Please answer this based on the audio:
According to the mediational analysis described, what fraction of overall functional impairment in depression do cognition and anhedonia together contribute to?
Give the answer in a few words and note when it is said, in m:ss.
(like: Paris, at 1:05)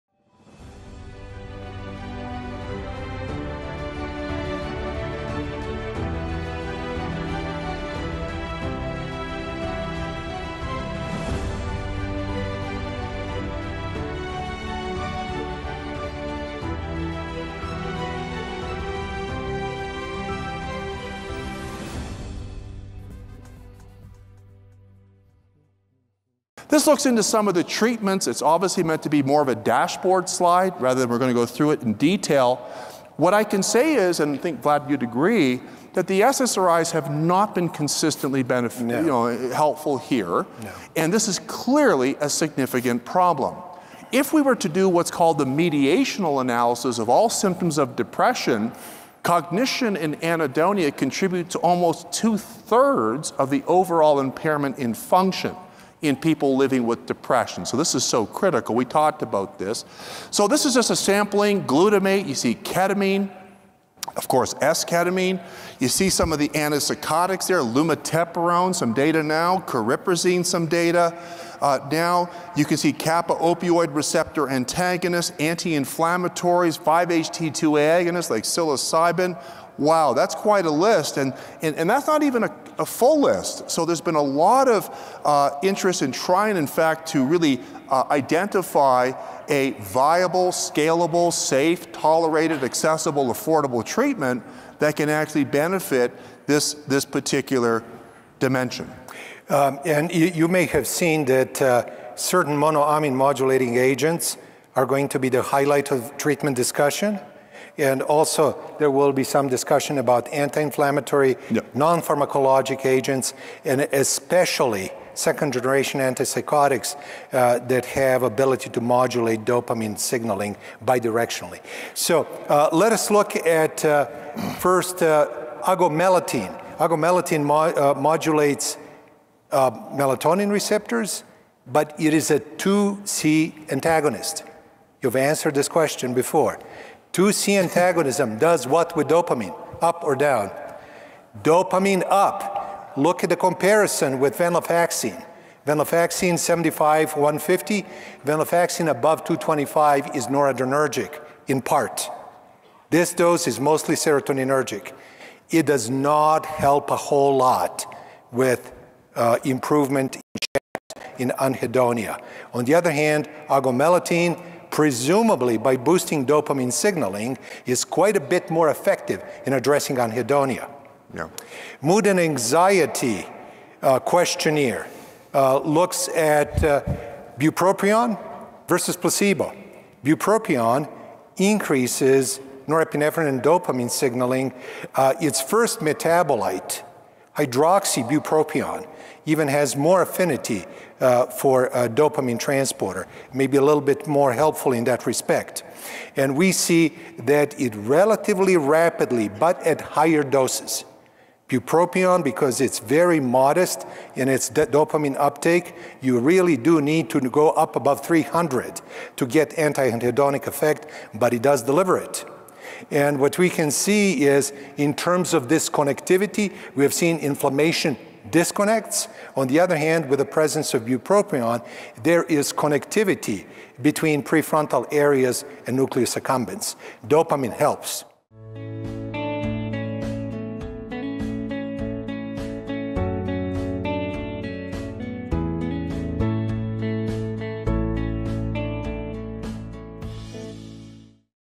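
almost two thirds, at 0:51.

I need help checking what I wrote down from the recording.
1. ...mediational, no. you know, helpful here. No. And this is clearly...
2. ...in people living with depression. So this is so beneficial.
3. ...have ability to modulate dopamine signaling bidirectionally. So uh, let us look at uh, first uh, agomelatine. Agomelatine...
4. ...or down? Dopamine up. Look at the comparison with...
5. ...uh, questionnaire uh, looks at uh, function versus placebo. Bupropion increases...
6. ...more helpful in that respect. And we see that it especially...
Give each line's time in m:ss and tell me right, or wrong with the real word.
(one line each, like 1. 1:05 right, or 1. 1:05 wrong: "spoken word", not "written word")
1. 0:38 wrong: "beneficial", not "mediational"
2. 0:56 wrong: "critical", not "beneficial"
3. 1:57 right
4. 2:20 right
5. 2:53 wrong: "bupropion", not "function"
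6. 3:14 wrong: "relatively", not "especially".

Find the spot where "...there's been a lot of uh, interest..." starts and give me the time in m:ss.
1:23.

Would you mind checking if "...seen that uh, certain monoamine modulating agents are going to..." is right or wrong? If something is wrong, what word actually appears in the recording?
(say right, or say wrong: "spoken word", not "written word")
right.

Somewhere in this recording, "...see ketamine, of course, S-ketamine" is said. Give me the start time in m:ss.
1:02.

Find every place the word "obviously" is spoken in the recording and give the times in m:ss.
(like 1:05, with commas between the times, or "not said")
0:28.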